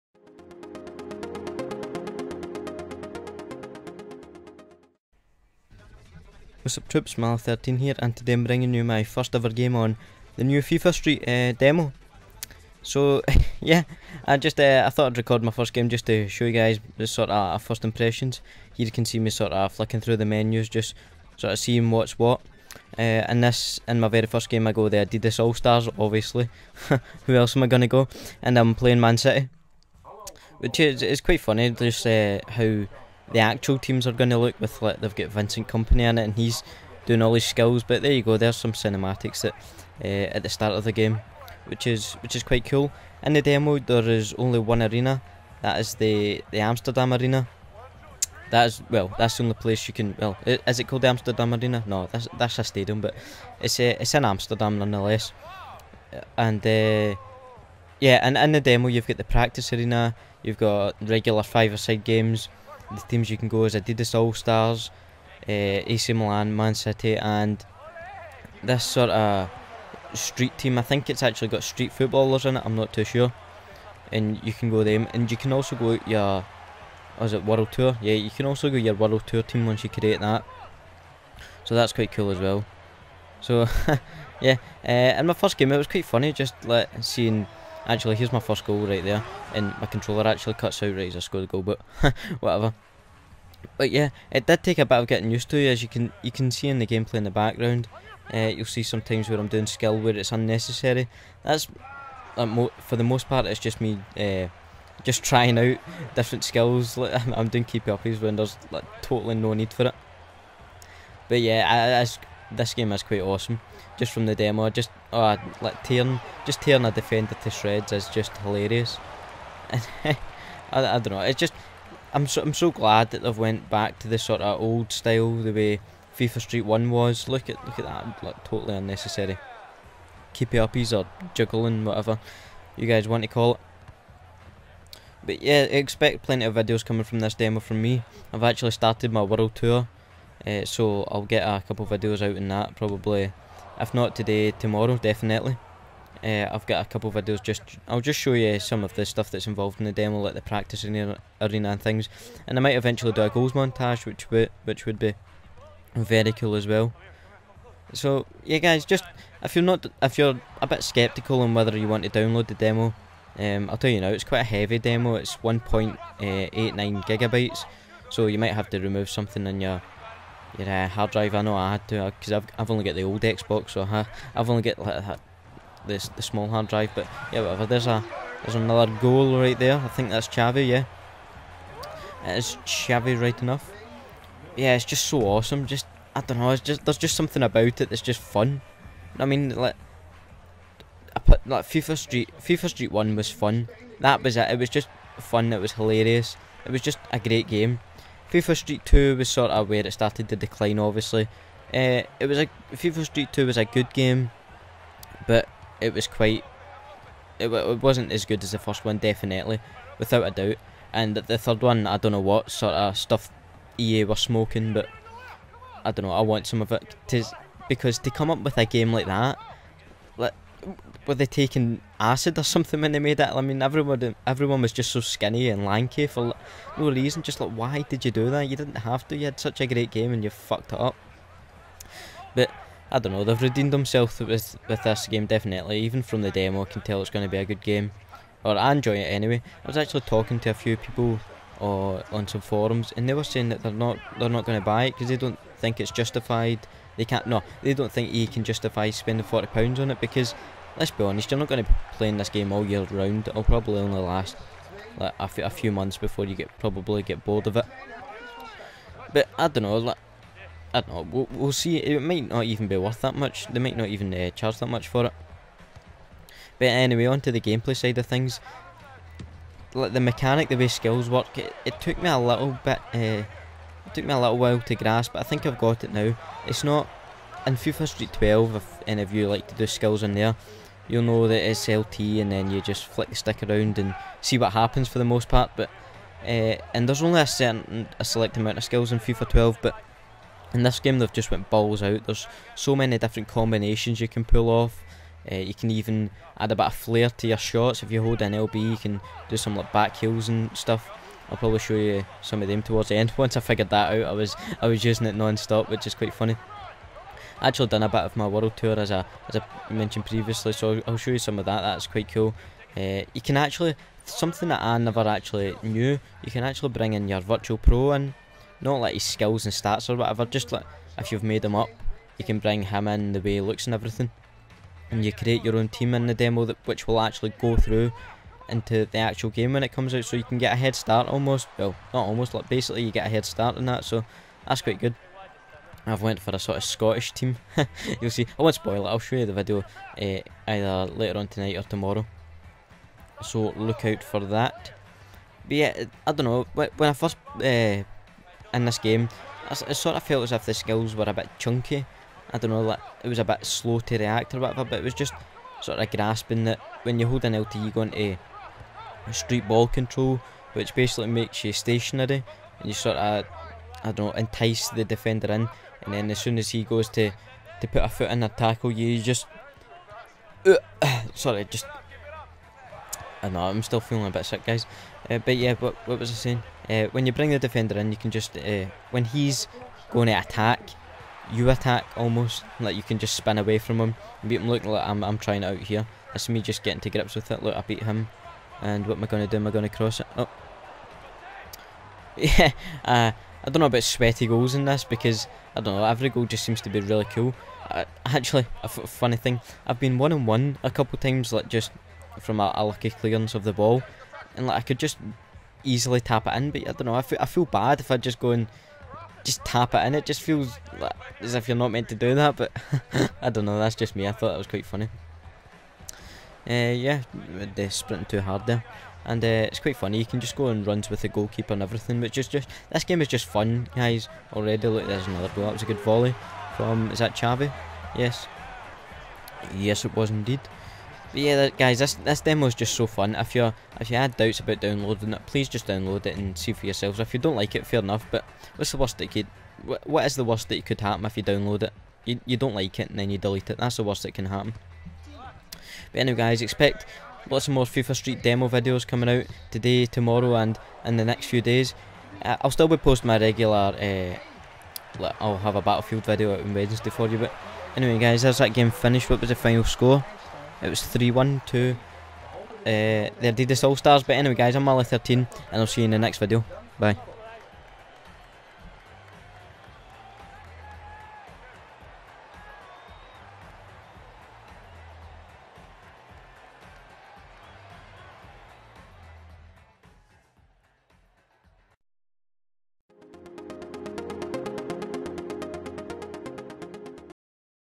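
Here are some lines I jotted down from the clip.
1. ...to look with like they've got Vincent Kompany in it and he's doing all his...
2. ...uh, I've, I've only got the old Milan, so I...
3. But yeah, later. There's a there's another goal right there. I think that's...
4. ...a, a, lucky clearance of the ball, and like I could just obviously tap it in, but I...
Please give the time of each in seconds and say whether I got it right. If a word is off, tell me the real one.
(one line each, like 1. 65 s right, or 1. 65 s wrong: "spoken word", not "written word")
1. 34 s right
2. 172 s wrong: "Xbox", not "Milan"
3. 176 s wrong: "whatever", not "later"
4. 402 s wrong: "easily", not "obviously".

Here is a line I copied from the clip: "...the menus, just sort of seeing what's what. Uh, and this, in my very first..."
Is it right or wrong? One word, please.
right.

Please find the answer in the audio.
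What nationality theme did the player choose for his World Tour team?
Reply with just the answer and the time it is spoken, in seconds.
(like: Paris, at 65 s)
Scottish, at 336 s.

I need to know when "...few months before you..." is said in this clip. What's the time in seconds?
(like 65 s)
255 s.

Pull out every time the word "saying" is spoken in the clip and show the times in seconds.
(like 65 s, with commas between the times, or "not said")
243 s, 376 s.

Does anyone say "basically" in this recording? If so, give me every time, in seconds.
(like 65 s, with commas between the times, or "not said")
332 s, 360 s.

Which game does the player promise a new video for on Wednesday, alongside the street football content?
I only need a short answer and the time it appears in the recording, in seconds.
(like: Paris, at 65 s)
Battlefield, at 455 s.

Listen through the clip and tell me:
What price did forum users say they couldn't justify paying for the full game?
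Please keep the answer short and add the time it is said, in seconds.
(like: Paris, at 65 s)
£40, at 249 s.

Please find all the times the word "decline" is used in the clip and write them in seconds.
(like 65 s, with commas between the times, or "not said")
200 s.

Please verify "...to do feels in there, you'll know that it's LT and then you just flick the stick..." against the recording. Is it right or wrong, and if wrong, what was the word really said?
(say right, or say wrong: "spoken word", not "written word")
wrong: "skills", not "feels".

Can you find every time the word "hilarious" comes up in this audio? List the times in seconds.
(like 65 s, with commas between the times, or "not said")
118 s, 195 s.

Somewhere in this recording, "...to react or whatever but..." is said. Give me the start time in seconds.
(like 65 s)
353 s.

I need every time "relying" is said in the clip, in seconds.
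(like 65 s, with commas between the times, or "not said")
not said.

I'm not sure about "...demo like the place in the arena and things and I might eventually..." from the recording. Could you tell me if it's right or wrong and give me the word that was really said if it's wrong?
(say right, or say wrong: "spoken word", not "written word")
wrong: "practice", not "place".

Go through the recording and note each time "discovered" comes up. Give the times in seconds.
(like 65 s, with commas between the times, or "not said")
not said.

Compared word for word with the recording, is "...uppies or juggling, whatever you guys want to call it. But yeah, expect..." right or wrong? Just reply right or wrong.
right.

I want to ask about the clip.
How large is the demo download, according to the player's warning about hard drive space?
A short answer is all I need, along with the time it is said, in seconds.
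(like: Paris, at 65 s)
1.89 gigabytes, at 165 s.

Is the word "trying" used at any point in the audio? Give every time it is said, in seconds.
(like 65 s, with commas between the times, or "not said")
105 s, 385 s.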